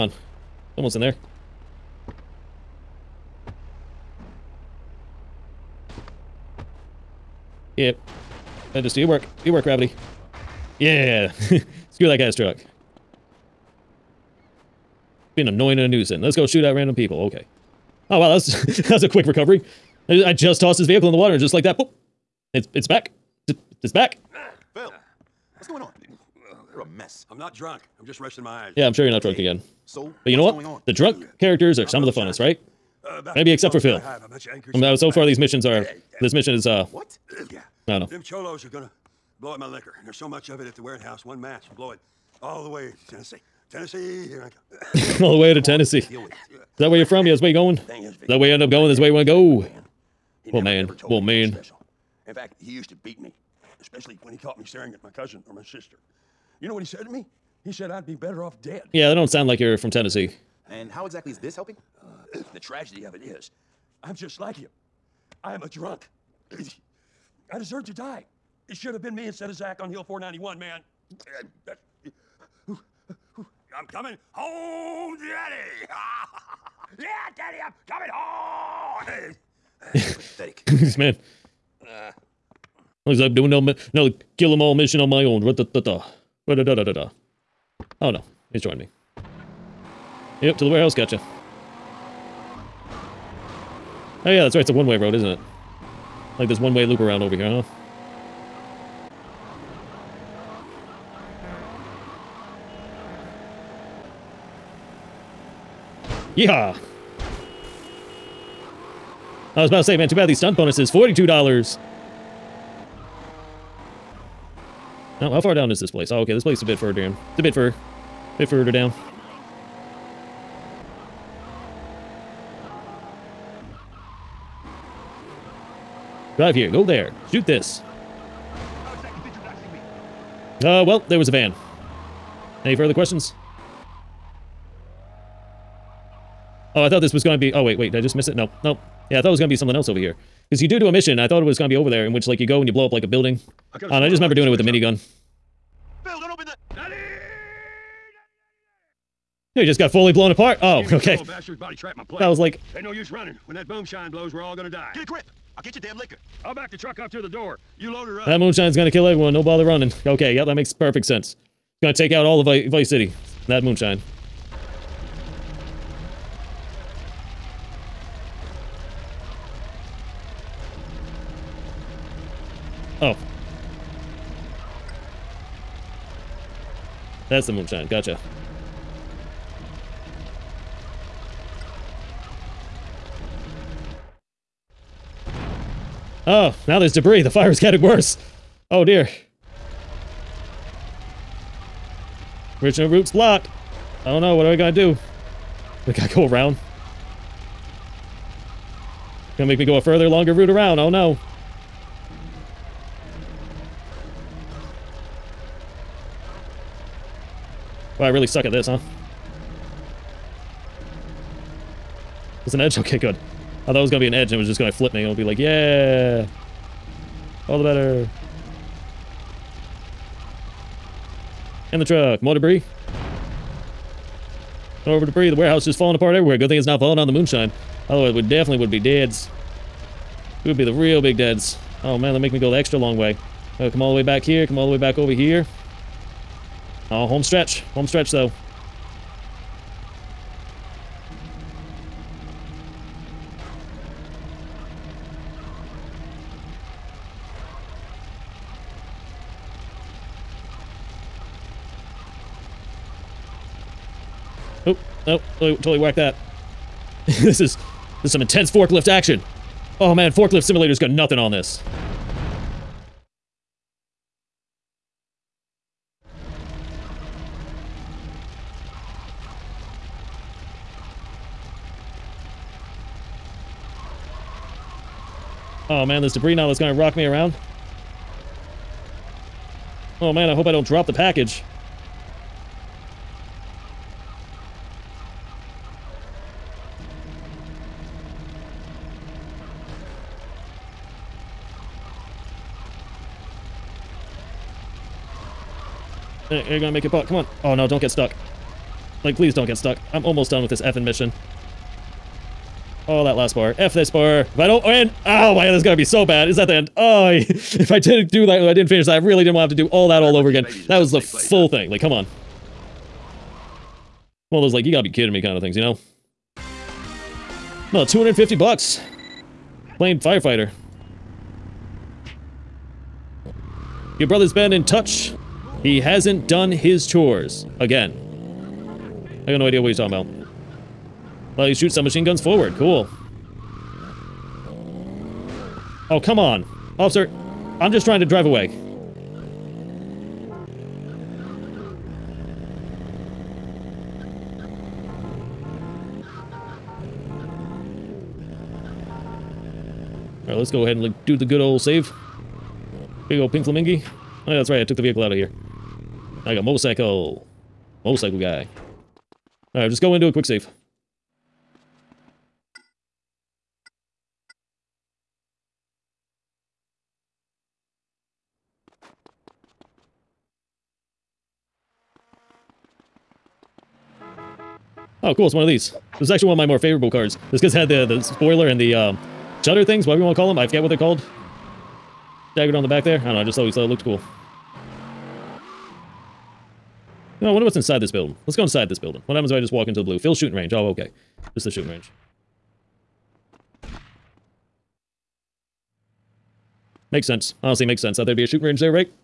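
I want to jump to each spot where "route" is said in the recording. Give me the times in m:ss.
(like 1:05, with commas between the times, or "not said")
3:12, 3:20.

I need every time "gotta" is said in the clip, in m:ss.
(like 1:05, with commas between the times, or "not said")
3:15, 5:14.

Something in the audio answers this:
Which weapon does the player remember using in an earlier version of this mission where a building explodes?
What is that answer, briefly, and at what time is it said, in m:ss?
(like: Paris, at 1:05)
minigun, at 2:24.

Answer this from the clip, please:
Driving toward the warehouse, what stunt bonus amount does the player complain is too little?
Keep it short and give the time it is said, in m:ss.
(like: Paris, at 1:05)
$42, at 1:50.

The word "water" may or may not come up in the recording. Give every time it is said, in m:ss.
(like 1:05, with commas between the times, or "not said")
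0:21.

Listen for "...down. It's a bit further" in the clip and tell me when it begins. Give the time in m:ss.
1:56.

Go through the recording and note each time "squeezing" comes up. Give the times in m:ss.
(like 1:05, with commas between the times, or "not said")
not said.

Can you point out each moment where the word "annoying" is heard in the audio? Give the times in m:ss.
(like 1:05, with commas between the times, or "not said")
0:15.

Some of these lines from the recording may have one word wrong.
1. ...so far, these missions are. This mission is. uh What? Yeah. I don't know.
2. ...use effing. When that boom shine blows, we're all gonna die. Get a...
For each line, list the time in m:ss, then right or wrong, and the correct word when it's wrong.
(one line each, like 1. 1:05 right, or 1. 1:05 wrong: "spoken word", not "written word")
1. 0:34 right
2. 2:32 wrong: "running", not "effing".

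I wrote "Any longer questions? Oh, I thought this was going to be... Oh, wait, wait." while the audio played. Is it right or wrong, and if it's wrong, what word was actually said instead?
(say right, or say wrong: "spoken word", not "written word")
wrong: "further", not "longer".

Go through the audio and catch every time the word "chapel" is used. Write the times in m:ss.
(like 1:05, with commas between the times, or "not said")
not said.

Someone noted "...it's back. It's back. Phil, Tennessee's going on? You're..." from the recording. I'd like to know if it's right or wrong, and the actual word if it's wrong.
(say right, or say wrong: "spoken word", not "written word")
wrong: "What", not "Tennessee".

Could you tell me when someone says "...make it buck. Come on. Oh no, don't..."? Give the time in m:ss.
4:56.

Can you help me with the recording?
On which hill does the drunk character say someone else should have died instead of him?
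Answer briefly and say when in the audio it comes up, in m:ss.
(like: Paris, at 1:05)
Hill 491, at 1:09.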